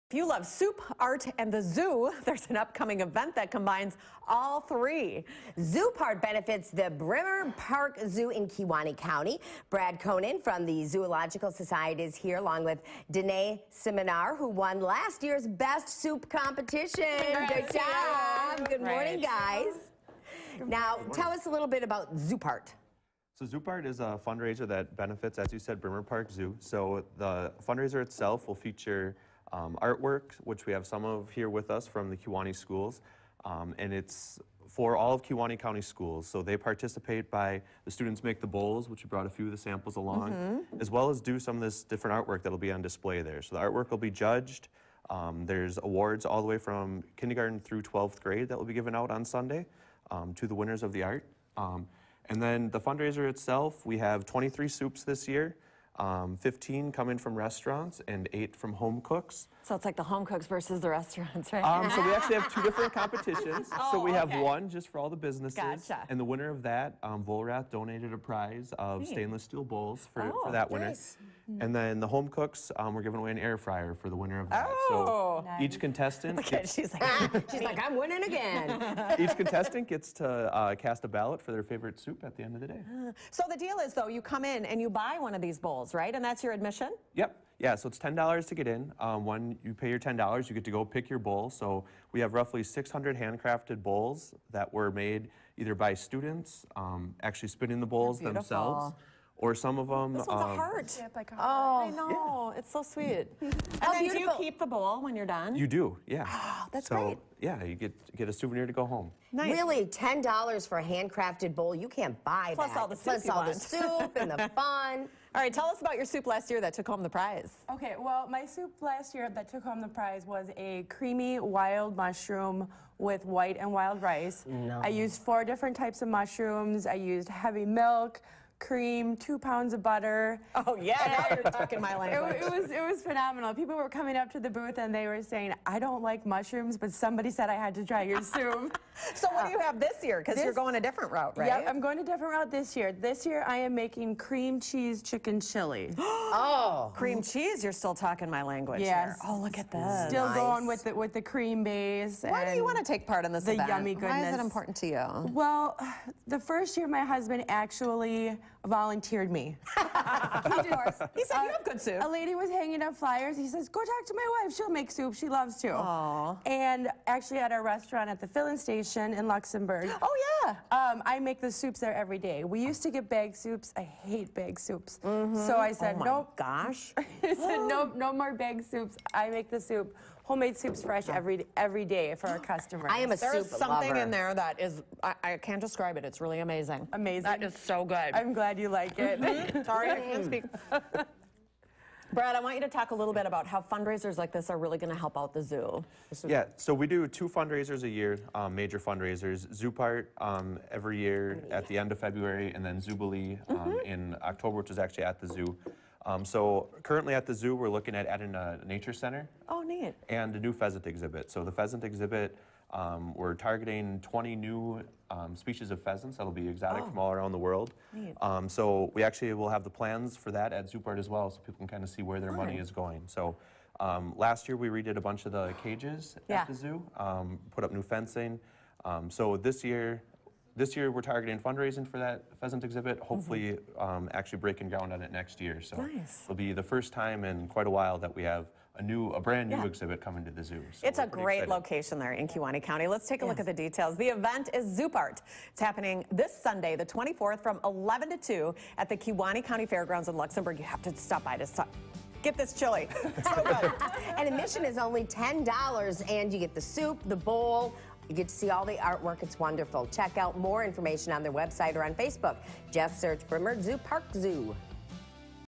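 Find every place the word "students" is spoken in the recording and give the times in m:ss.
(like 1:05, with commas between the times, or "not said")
0:37, 1:35.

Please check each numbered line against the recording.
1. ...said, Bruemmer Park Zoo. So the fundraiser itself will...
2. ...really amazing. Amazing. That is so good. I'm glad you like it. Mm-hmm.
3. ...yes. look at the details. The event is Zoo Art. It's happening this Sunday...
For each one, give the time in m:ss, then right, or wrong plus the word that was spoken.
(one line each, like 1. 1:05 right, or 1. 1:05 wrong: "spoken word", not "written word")
1. 0:25 right
2. 3:06 right
3. 4:03 right.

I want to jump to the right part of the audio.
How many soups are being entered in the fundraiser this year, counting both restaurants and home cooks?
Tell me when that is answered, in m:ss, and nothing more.
0:54.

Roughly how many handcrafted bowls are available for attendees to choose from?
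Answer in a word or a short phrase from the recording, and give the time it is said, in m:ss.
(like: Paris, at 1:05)
600, at 1:32.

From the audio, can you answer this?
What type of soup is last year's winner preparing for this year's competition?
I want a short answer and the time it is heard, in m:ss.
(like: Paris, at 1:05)
Cream cheese chicken chili, at 2:24.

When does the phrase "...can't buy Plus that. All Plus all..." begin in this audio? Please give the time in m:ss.
1:51.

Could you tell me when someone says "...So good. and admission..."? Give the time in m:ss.
4:13.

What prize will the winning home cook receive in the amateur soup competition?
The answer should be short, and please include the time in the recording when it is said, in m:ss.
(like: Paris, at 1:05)
An air fryer, at 1:13.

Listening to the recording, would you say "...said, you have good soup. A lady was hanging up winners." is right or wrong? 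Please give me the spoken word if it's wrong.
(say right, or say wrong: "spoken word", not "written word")
wrong: "flyers", not "winners".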